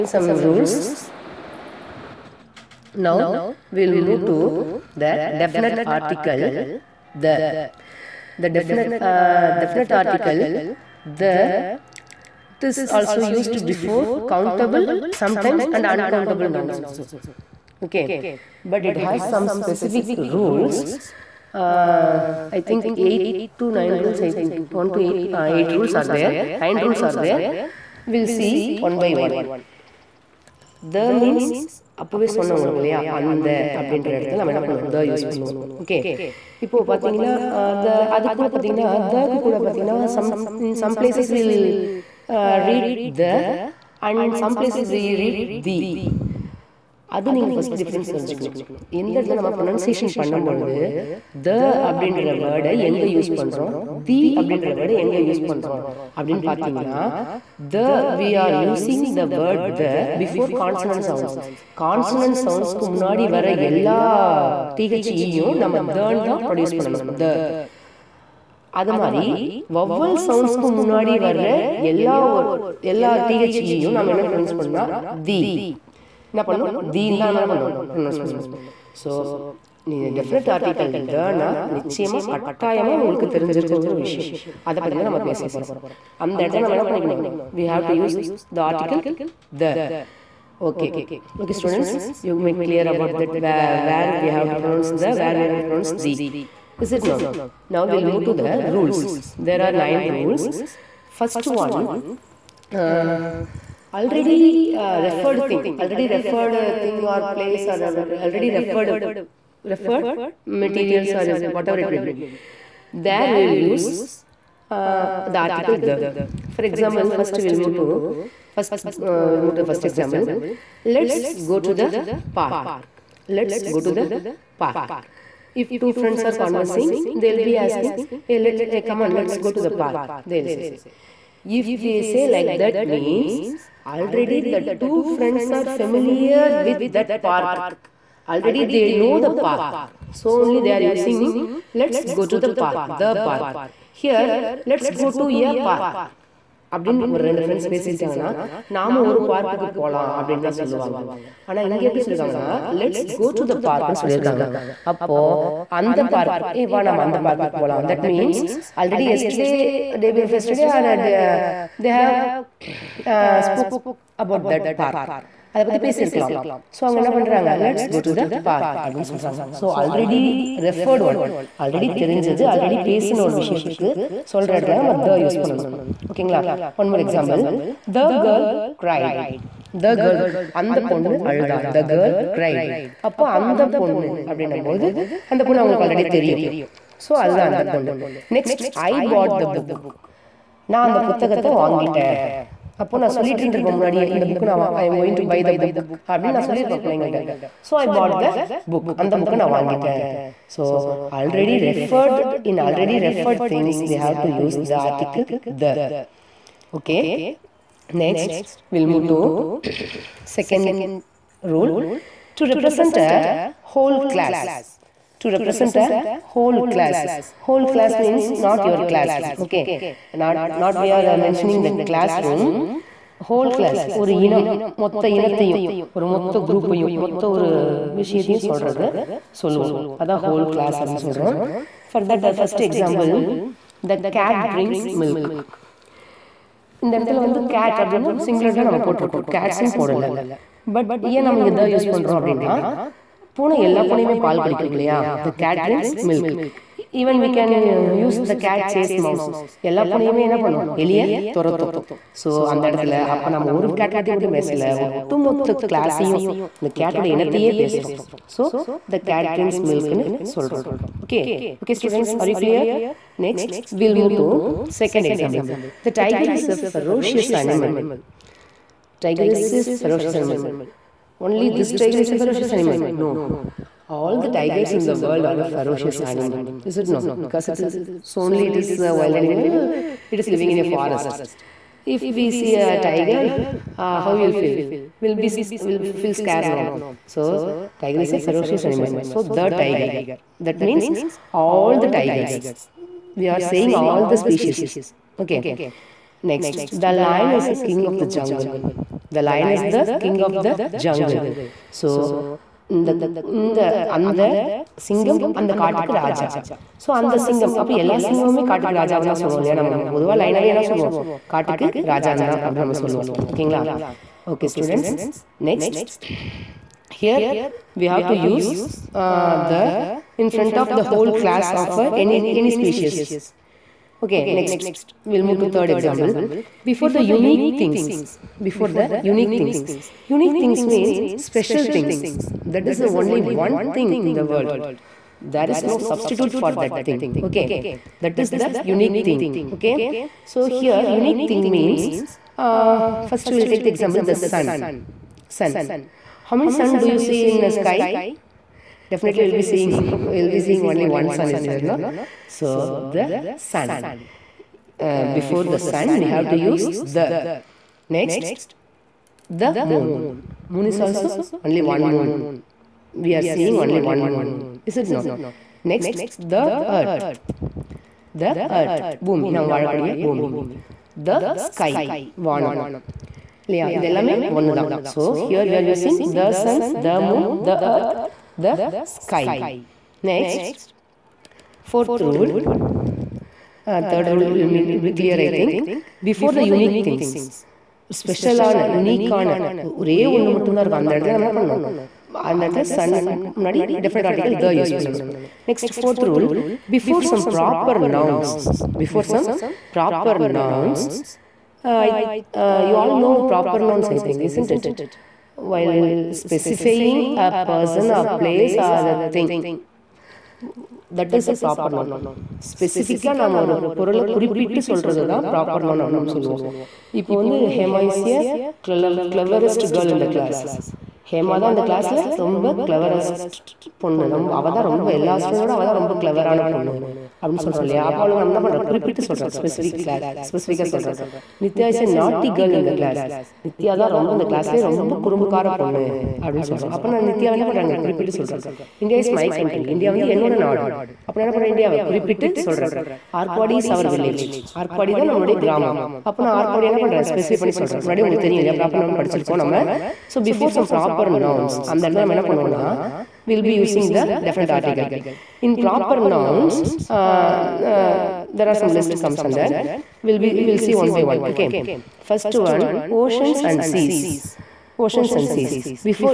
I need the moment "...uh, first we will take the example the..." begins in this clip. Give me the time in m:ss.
5:42.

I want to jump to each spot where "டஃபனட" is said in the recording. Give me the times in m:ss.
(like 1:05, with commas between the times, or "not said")
1:20, 6:33.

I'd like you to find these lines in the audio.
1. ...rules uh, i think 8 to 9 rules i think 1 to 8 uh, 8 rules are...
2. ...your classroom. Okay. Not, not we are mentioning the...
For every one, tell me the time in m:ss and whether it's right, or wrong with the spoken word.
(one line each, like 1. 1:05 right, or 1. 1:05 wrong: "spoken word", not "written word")
1. 0:20 right
2. 3:38 right.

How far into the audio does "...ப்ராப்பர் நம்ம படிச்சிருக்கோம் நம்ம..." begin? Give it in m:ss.
7:28.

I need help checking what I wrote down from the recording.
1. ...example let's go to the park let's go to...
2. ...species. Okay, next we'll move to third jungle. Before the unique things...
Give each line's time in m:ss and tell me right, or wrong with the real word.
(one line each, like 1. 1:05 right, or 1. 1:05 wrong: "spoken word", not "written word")
1. 1:59 right
2. 5:22 wrong: "example", not "jungle".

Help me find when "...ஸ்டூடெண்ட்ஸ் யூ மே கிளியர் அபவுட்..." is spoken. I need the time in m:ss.
1:31.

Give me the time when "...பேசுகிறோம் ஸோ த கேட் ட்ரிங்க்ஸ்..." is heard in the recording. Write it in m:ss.
4:17.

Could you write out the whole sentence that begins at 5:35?
There is no substitute for that thing.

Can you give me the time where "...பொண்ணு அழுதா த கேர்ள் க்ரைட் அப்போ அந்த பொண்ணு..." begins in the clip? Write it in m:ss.
3:00.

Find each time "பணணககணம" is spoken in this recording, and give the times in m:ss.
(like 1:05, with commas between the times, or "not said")
1:26.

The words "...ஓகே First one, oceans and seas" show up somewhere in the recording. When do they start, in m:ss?
7:41.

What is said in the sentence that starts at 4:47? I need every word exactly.
So tiger is a ferocious animal.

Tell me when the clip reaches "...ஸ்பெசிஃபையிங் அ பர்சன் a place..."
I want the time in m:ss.
6:46.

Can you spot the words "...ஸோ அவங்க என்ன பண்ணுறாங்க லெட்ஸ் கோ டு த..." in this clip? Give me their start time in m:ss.
2:46.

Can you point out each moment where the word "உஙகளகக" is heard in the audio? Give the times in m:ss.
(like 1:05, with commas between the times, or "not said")
0:32, 1:23, 7:28.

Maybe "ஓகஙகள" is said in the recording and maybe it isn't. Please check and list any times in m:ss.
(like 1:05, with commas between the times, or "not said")
2:56, 5:13.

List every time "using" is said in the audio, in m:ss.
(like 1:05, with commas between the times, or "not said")
2:20, 6:15.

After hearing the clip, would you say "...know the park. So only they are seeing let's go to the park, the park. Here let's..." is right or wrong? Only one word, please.
wrong.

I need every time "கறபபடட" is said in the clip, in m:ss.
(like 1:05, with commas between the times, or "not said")
6:54, 7:08, 7:17, 7:21.